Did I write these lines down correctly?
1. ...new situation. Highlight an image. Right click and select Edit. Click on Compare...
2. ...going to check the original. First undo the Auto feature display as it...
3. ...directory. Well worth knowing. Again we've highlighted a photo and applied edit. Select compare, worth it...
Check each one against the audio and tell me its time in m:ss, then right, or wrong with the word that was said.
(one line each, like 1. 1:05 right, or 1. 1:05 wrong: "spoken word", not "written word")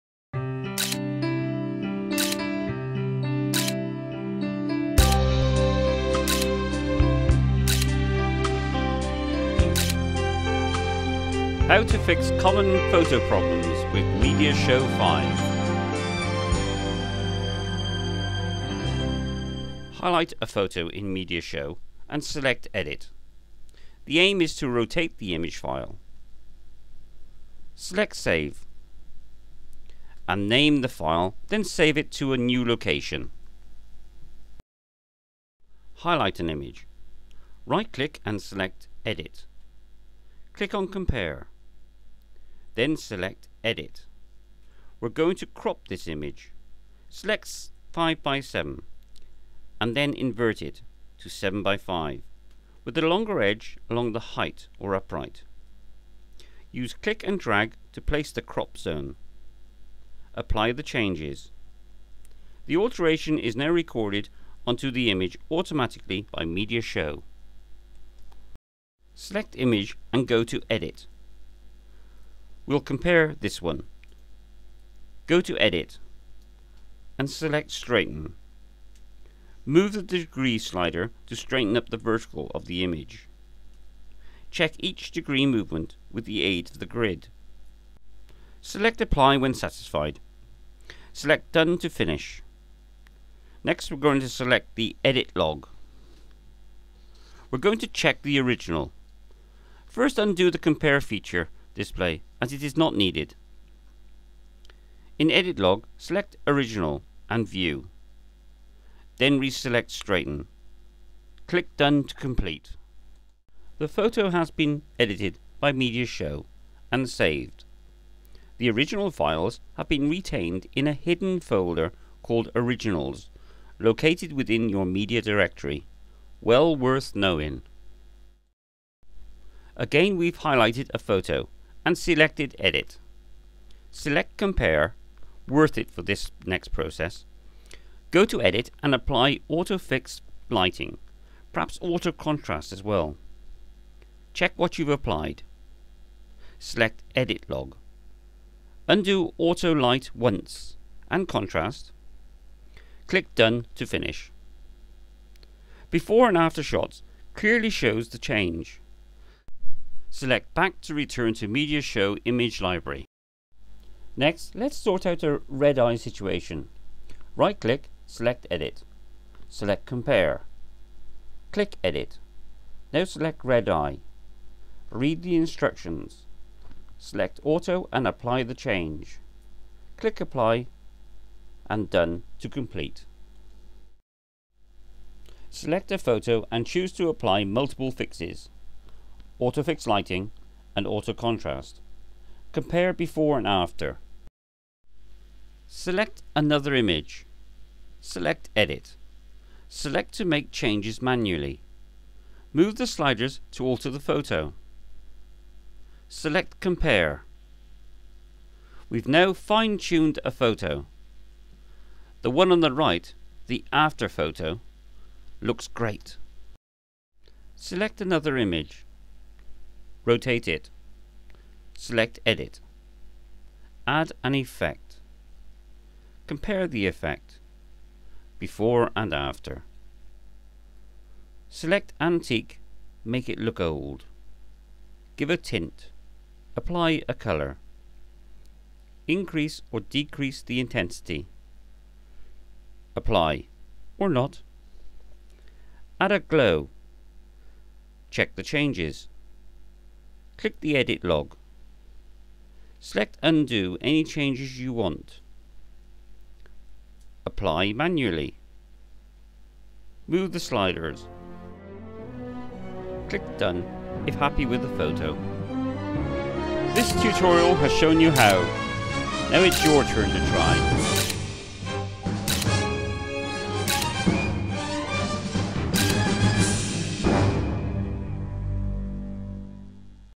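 1. 0:32 wrong: "location", not "situation"
2. 1:37 wrong: "Compare", not "Auto"
3. 2:05 wrong: "selected", not "applied".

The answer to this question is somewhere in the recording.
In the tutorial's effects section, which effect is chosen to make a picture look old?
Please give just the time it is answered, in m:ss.
3:52.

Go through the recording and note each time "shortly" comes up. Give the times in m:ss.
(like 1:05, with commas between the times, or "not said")
not said.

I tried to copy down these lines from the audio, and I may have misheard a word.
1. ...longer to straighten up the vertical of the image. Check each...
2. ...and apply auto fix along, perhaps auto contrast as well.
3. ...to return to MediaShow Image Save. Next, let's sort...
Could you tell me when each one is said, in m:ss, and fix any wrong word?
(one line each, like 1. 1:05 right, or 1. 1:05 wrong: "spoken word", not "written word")
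1. 1:20 wrong: "slider", not "longer"
2. 2:18 wrong: "lighting", not "along"
3. 2:40 wrong: "Library", not "Save".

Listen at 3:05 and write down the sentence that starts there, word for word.
Select a photo and choose to apply multiple fixes autofix lighting and auto contrast.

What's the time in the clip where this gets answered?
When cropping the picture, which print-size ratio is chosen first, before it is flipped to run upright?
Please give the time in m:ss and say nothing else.
0:47.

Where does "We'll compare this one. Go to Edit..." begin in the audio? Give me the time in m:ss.
1:12.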